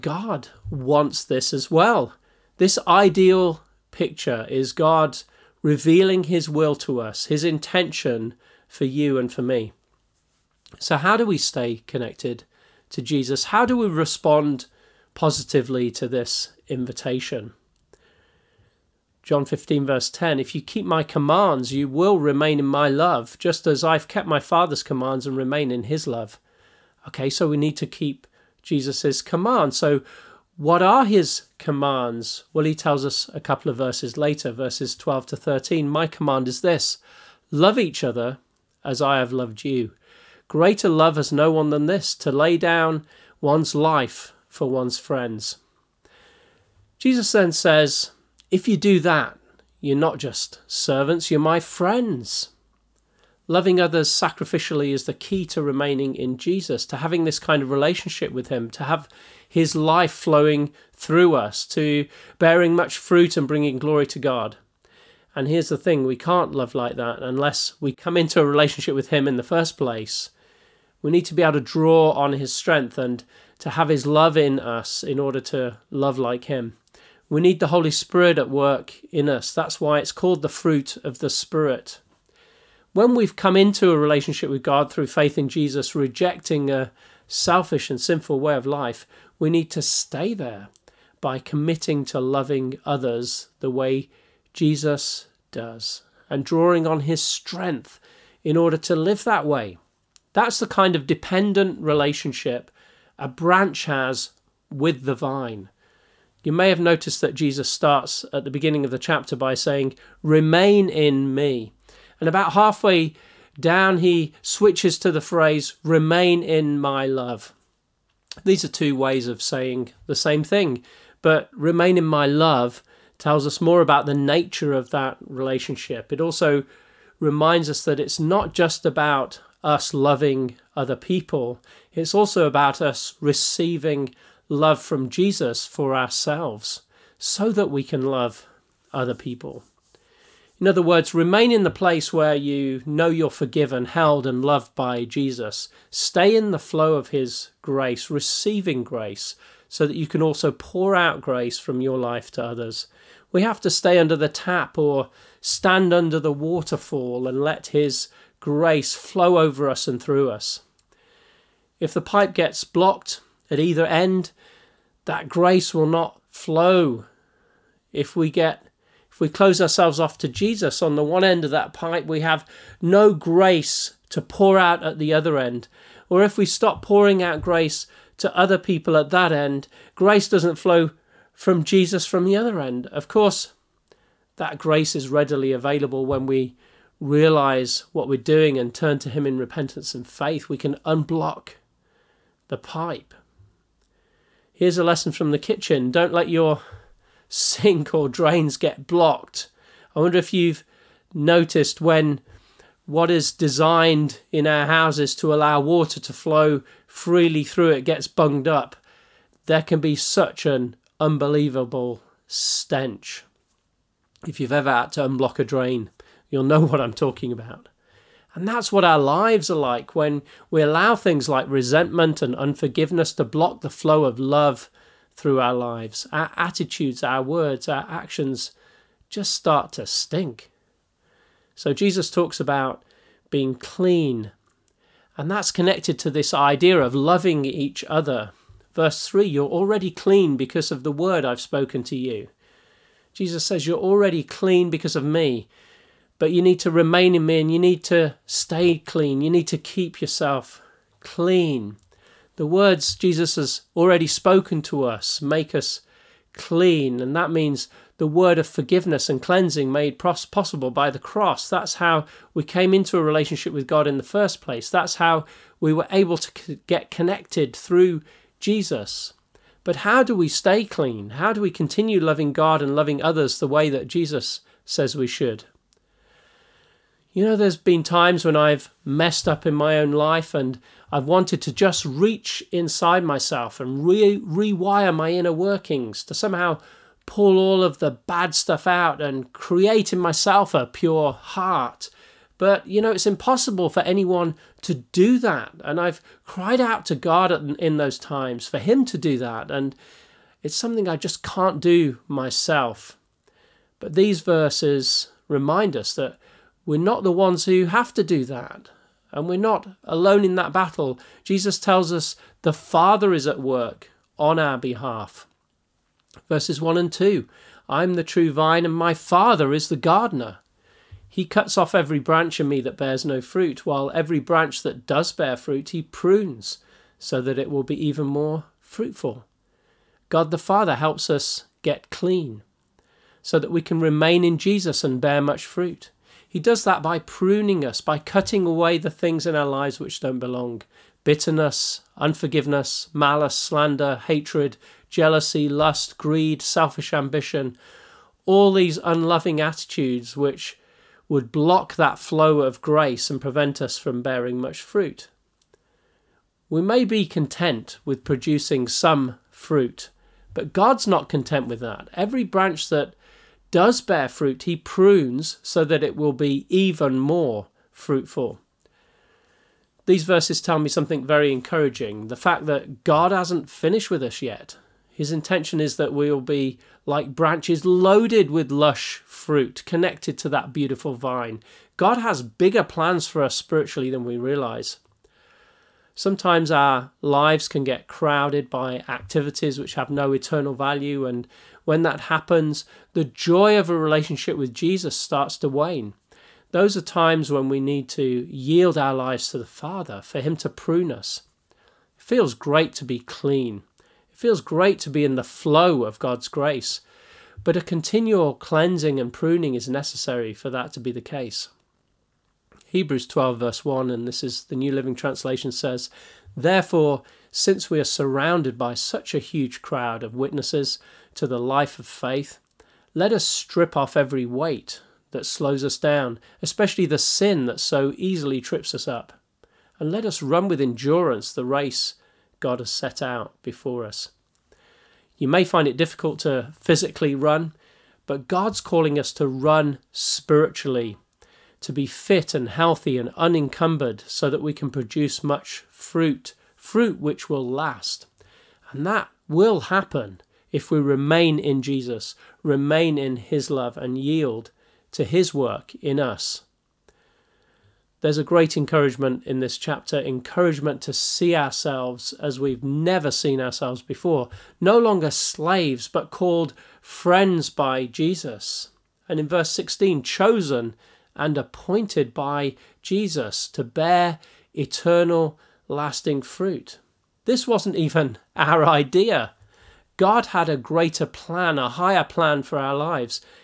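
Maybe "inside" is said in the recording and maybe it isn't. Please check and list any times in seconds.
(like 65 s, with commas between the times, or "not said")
282 s.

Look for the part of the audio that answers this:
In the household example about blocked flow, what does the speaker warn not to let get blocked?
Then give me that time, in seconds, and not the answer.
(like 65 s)
197 s.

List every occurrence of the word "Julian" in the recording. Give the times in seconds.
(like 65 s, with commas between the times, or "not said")
not said.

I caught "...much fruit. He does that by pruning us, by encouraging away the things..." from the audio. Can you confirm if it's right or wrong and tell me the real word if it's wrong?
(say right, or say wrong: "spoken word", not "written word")
wrong: "cutting", not "encouraging".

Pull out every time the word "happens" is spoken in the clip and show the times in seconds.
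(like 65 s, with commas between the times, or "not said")
392 s, 449 s.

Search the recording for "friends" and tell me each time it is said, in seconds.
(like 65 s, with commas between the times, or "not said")
44 s, 51 s, 466 s.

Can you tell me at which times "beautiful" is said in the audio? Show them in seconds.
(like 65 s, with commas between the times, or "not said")
380 s.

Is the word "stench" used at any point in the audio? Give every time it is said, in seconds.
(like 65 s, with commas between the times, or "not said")
212 s.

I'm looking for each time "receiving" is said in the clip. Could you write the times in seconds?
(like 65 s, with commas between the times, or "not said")
133 s, 148 s.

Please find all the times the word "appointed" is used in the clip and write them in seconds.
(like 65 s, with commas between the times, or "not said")
471 s.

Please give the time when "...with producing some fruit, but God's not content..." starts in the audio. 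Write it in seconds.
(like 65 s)
357 s.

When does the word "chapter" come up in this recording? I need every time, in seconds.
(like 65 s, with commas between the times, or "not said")
108 s, 459 s.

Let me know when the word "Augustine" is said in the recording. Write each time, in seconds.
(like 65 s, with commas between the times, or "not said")
not said.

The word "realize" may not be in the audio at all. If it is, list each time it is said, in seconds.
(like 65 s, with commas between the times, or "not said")
186 s, 384 s.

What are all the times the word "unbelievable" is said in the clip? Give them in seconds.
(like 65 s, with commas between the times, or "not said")
210 s.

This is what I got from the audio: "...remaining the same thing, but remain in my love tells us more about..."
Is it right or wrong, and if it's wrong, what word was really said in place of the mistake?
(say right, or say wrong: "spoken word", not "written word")
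wrong: "saying", not "remaining".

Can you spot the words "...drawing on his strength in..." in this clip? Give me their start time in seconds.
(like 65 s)
96 s.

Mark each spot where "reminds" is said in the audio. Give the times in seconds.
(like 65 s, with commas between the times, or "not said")
127 s, 305 s.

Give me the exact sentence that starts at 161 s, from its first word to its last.
If the pipe gets blocked, at either end, that grace will not flow.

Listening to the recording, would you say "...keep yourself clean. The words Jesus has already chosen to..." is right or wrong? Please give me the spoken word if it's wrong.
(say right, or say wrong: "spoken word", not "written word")
wrong: "spoken", not "chosen".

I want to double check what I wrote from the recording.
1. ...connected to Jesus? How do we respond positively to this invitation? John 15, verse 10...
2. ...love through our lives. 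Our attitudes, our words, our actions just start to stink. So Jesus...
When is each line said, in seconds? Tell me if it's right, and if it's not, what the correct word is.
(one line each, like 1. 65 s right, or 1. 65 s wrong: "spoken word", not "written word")
1. 11 s right
2. 224 s right.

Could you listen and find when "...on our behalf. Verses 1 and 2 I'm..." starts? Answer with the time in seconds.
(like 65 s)
314 s.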